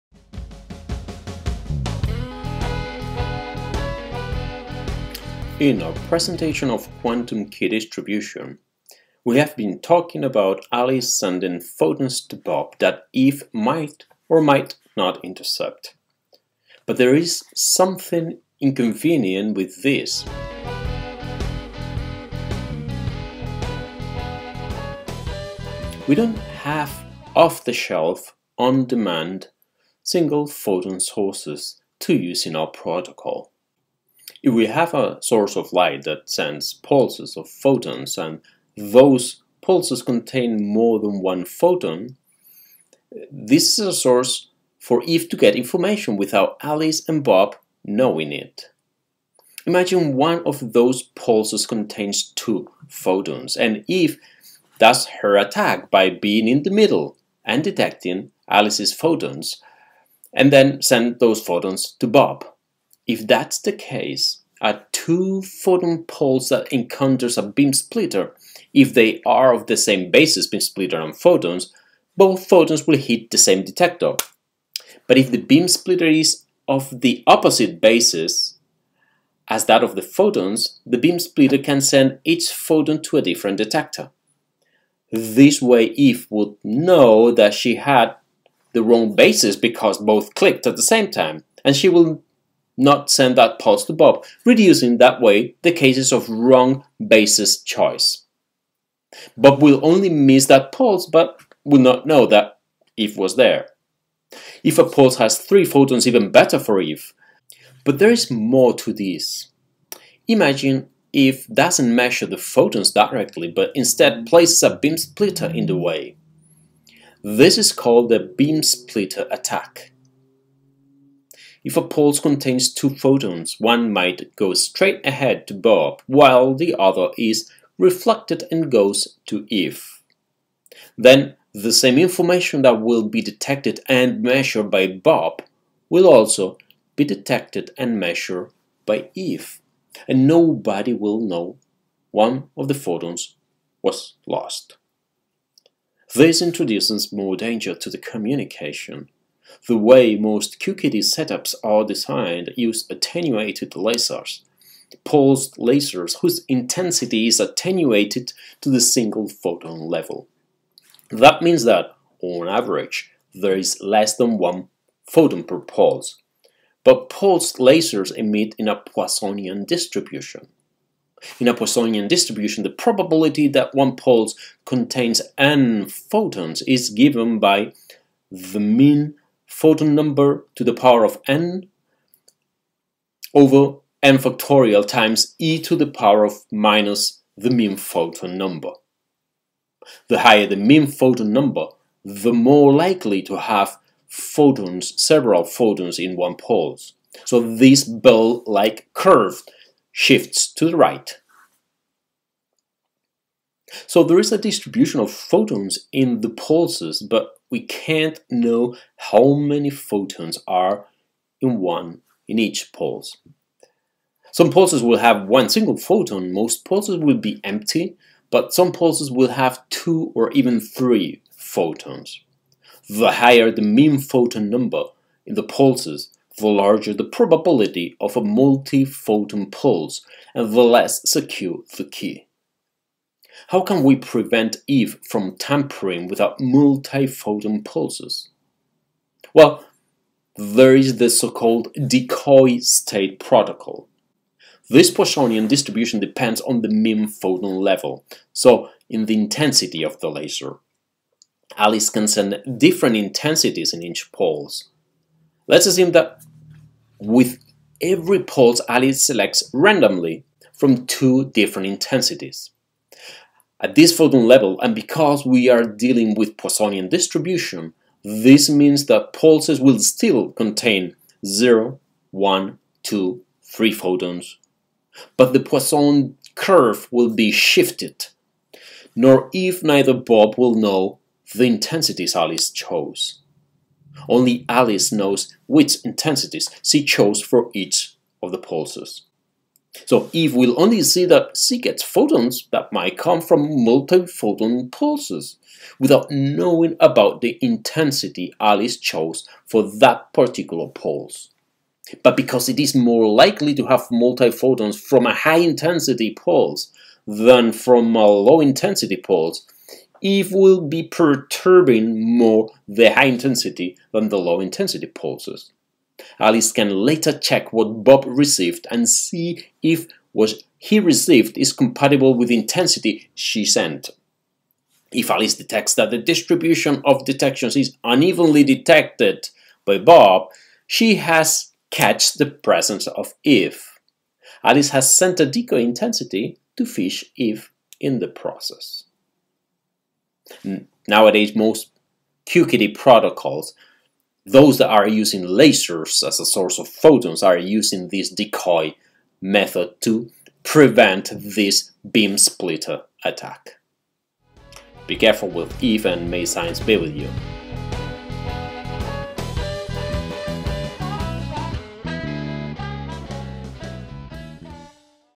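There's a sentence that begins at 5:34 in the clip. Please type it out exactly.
Alice has sent a decoy intensity to fish if in the process.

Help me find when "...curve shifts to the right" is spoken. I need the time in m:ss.
3:18.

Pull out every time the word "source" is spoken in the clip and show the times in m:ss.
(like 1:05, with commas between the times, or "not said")
0:30, 0:35, 0:43, 5:46.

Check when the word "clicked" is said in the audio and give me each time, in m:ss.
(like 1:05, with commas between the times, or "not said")
1:30.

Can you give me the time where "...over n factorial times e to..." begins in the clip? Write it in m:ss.
3:03.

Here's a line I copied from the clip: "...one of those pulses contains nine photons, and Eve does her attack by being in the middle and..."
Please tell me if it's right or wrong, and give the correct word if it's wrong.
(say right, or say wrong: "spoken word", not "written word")
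wrong: "two", not "nine".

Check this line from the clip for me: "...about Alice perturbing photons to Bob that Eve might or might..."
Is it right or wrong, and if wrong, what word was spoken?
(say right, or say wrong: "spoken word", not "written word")
wrong: "sending", not "perturbing".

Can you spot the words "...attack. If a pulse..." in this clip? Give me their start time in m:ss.
1:59.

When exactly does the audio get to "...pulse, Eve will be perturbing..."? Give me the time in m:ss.
5:08.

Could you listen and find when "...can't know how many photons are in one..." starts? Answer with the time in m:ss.
3:27.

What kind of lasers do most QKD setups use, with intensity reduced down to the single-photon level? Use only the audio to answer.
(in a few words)
attenuated lasers.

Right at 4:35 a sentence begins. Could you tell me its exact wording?
But the Poisson curve will be shifted, nor Eve neither Bob will know the intensities Alice chose.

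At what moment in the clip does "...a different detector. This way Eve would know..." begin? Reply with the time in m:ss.
1:23.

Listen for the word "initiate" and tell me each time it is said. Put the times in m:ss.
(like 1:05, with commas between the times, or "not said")
not said.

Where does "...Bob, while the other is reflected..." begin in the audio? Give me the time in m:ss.
2:05.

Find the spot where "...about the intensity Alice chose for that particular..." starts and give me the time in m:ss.
4:56.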